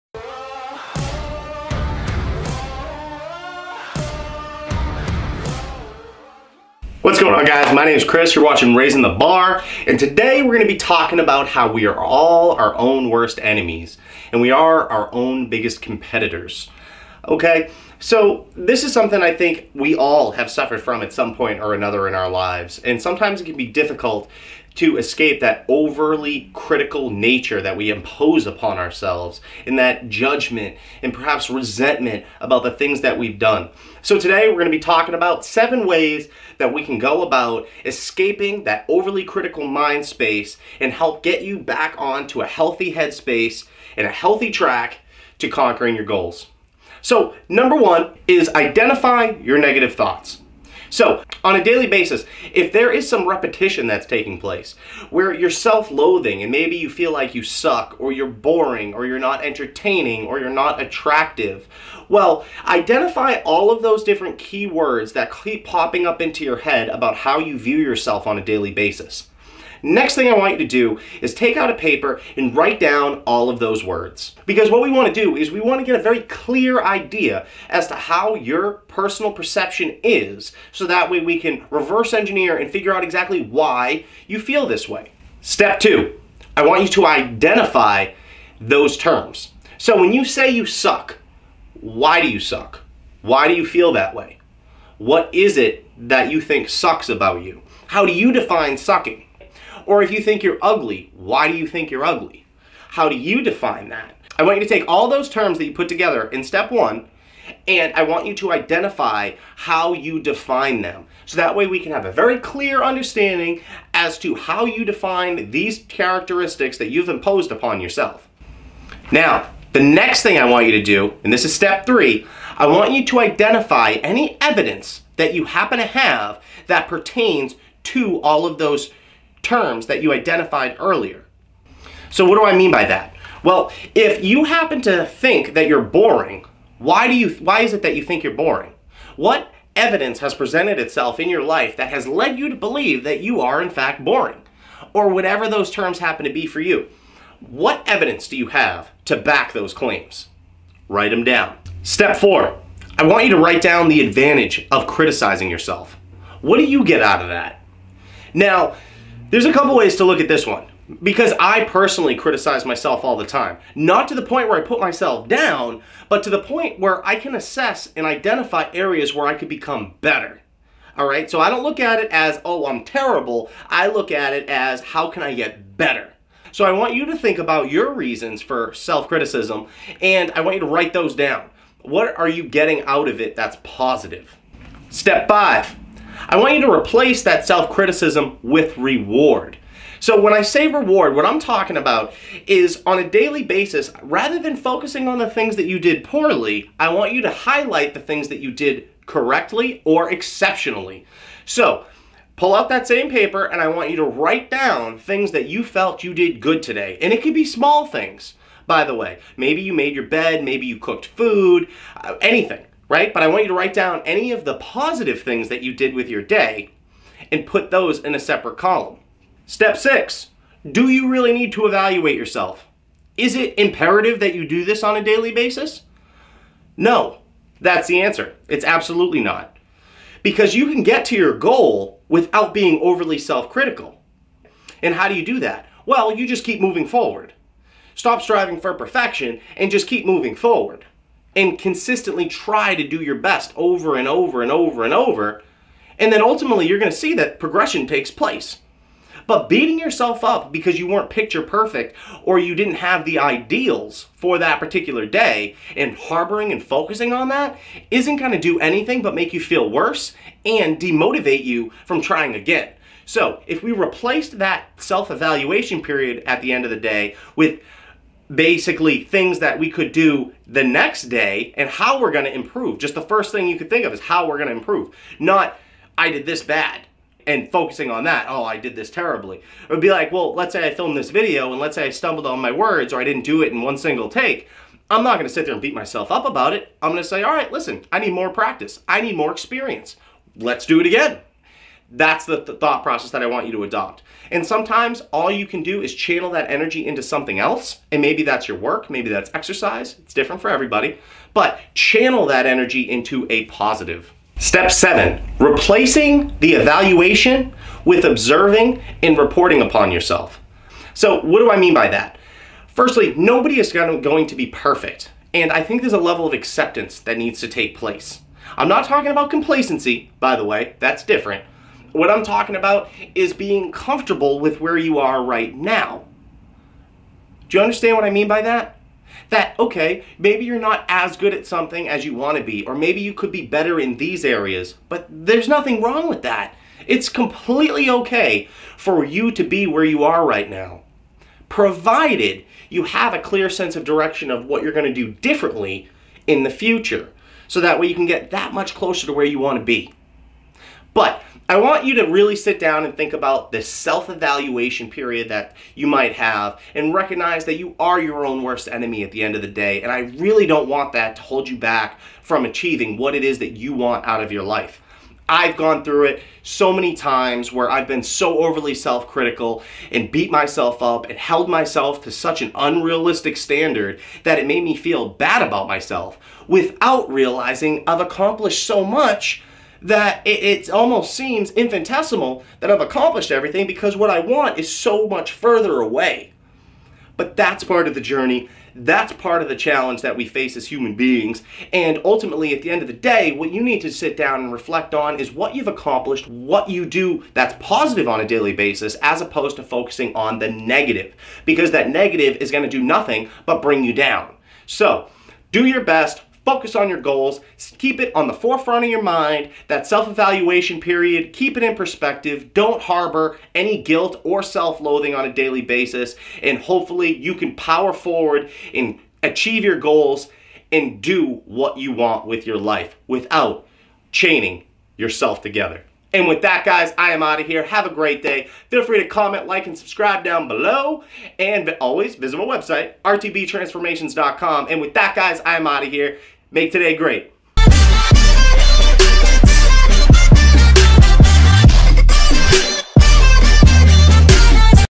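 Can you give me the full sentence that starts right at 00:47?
So, number one is identify your negative thoughts.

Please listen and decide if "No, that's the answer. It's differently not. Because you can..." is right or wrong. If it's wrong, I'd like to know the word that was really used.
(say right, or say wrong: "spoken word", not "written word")
wrong: "absolutely", not "differently".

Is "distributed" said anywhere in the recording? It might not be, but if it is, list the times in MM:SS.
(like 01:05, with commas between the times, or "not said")
not said.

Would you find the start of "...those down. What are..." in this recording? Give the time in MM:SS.
03:00.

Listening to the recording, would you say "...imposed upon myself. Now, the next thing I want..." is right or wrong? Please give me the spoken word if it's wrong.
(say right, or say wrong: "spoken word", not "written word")
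wrong: "yourself", not "myself".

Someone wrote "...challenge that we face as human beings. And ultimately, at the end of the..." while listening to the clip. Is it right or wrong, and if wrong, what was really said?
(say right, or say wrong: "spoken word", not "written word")
right.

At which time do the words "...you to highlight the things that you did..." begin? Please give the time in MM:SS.
03:17.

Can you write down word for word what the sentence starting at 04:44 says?
I'm not going to sit there and beat myself up about it.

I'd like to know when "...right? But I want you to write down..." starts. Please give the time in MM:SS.
03:32.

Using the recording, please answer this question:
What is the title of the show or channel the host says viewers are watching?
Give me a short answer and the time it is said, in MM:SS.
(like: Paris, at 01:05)
Raising the Bar, at 00:08.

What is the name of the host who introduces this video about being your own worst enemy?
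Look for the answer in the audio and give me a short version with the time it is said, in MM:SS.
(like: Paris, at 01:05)
Chris, at 00:08.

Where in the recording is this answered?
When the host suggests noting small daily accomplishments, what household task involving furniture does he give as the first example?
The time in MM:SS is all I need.
03:29.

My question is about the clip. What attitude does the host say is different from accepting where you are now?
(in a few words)
complacency.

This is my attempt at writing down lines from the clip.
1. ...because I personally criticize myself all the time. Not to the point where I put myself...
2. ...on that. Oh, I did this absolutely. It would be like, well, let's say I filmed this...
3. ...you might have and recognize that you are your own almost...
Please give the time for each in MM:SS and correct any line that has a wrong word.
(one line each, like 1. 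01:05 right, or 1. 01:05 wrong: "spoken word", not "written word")
1. 02:41 right
2. 04:37 wrong: "terribly", not "absolutely"
3. 05:55 wrong: "worst", not "almost".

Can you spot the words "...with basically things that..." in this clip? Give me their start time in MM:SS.
04:27.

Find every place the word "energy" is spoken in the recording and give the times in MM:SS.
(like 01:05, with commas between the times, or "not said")
04:56, 05:02.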